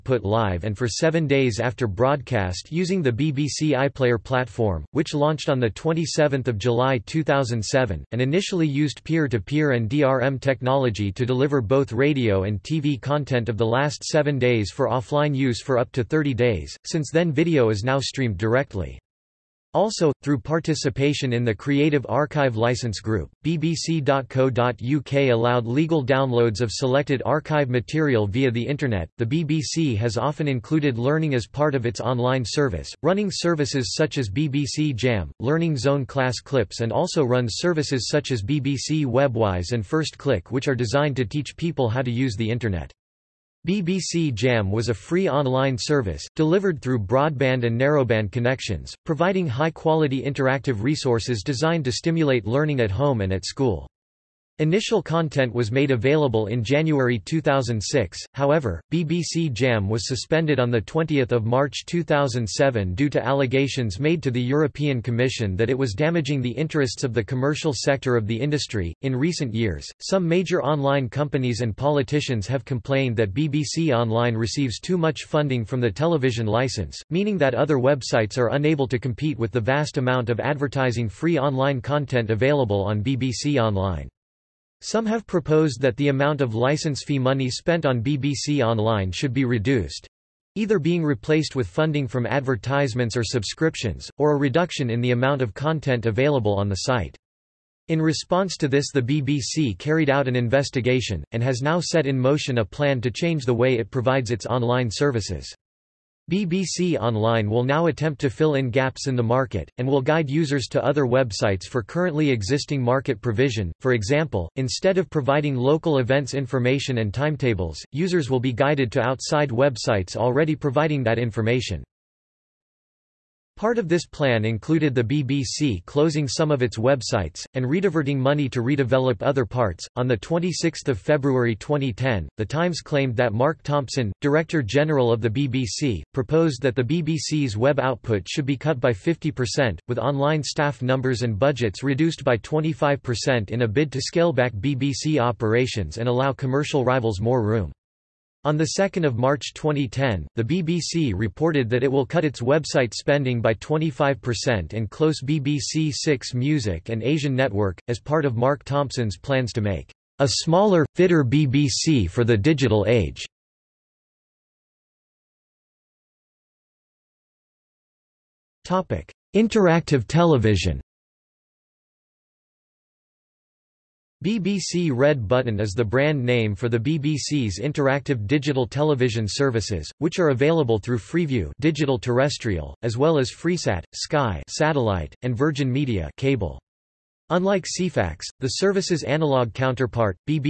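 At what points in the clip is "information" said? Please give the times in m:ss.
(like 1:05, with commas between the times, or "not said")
1:56, 2:01.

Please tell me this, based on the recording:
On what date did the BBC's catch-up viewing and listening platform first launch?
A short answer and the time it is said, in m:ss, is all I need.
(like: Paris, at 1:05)
27 July 2007, at 0:05.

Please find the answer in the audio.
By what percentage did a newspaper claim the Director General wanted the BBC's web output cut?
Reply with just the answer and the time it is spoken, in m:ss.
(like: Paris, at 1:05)
50%, at 2:18.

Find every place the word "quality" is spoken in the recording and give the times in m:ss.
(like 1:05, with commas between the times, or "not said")
0:49.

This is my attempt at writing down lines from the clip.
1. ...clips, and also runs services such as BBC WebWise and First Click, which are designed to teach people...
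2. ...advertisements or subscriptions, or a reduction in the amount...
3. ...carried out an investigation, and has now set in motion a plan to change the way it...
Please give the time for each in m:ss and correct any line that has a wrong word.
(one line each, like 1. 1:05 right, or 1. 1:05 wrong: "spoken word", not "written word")
1. 0:36 right
2. 1:32 right
3. 1:39 right.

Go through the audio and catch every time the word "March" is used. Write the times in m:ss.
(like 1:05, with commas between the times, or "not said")
1:01, 2:29.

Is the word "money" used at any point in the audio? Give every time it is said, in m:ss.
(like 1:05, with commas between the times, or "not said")
1:27, 2:08.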